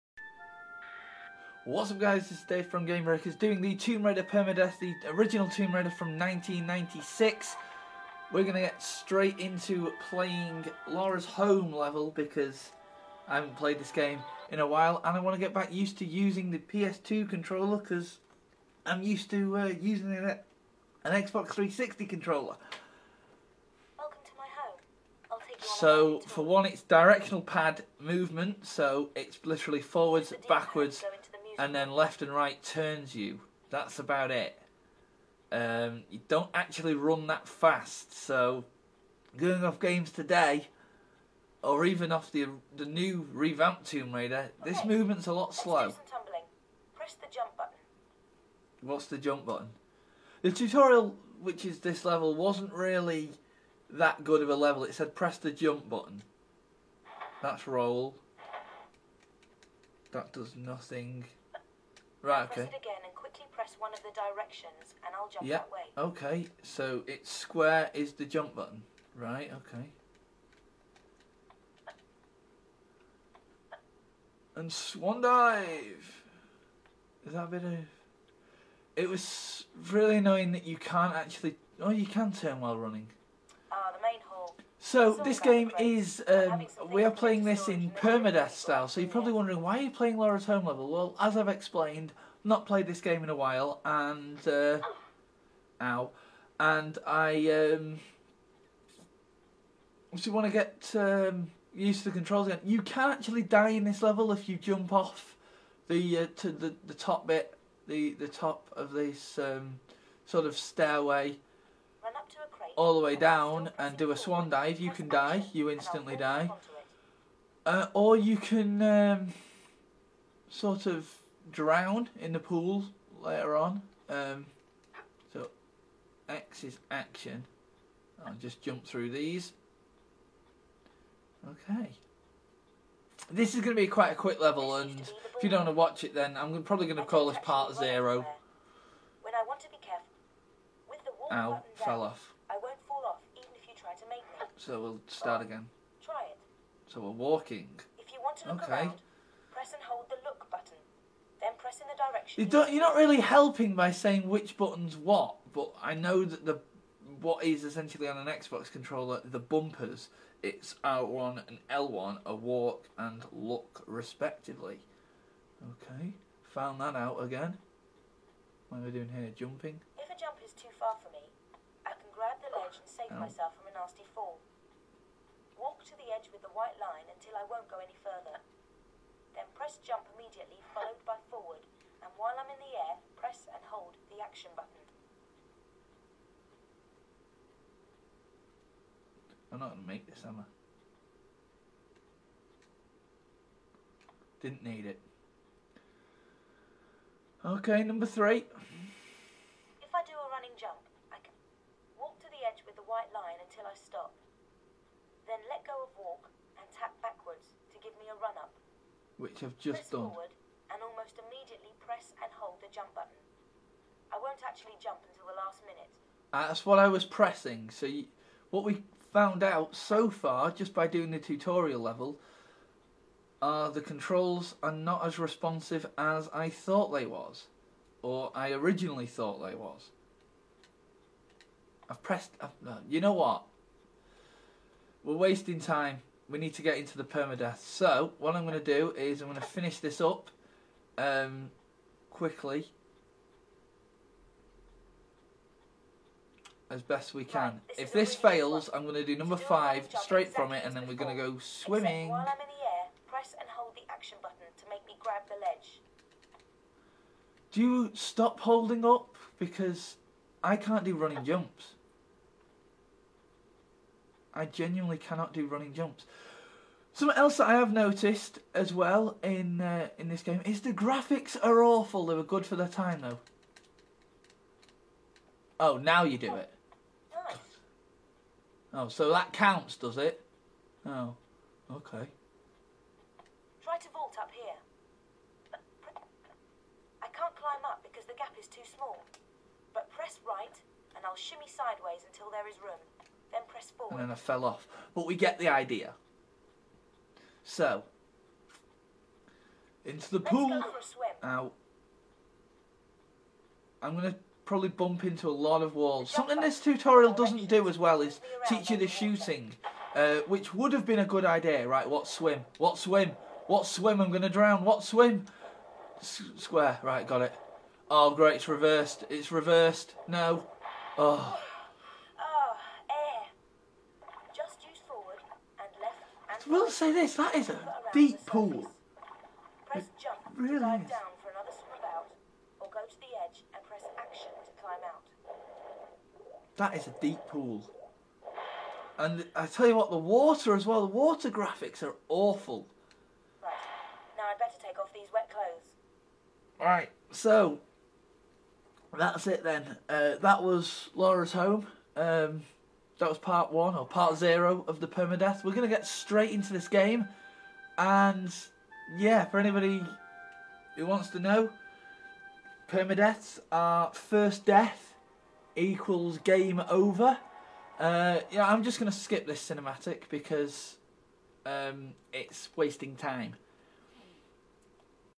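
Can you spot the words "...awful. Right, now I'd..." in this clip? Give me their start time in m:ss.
5:42.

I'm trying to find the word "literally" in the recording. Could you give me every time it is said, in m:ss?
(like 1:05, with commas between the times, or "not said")
0:29.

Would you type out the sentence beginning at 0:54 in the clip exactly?
It said press the jump button.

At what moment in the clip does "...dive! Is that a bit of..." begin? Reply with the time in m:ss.
1:15.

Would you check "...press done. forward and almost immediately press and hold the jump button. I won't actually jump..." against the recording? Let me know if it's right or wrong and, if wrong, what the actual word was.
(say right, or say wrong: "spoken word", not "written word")
right.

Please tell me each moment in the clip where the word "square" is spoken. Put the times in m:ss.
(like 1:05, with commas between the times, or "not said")
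1:07, 5:16.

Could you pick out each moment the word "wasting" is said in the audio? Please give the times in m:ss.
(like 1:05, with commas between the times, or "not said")
3:55, 6:12.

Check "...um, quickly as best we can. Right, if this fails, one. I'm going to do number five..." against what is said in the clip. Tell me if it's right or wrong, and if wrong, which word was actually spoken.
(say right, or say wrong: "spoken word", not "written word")
right.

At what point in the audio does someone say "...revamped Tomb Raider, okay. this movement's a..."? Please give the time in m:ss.
0:43.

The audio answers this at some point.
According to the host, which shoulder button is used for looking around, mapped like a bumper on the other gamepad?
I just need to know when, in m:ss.
2:41.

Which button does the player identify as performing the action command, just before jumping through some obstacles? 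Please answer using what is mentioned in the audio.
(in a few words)
X.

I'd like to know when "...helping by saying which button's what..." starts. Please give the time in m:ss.
2:33.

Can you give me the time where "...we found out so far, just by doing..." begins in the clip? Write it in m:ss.
3:38.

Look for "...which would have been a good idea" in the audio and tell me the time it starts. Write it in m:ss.
5:10.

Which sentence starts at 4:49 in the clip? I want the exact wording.
But press right, and I'll shimmy sideways until there is room.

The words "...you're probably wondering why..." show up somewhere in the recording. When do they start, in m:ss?
1:28.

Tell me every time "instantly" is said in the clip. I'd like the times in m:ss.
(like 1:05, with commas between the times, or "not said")
1:55.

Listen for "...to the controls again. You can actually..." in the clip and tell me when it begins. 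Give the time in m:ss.
1:41.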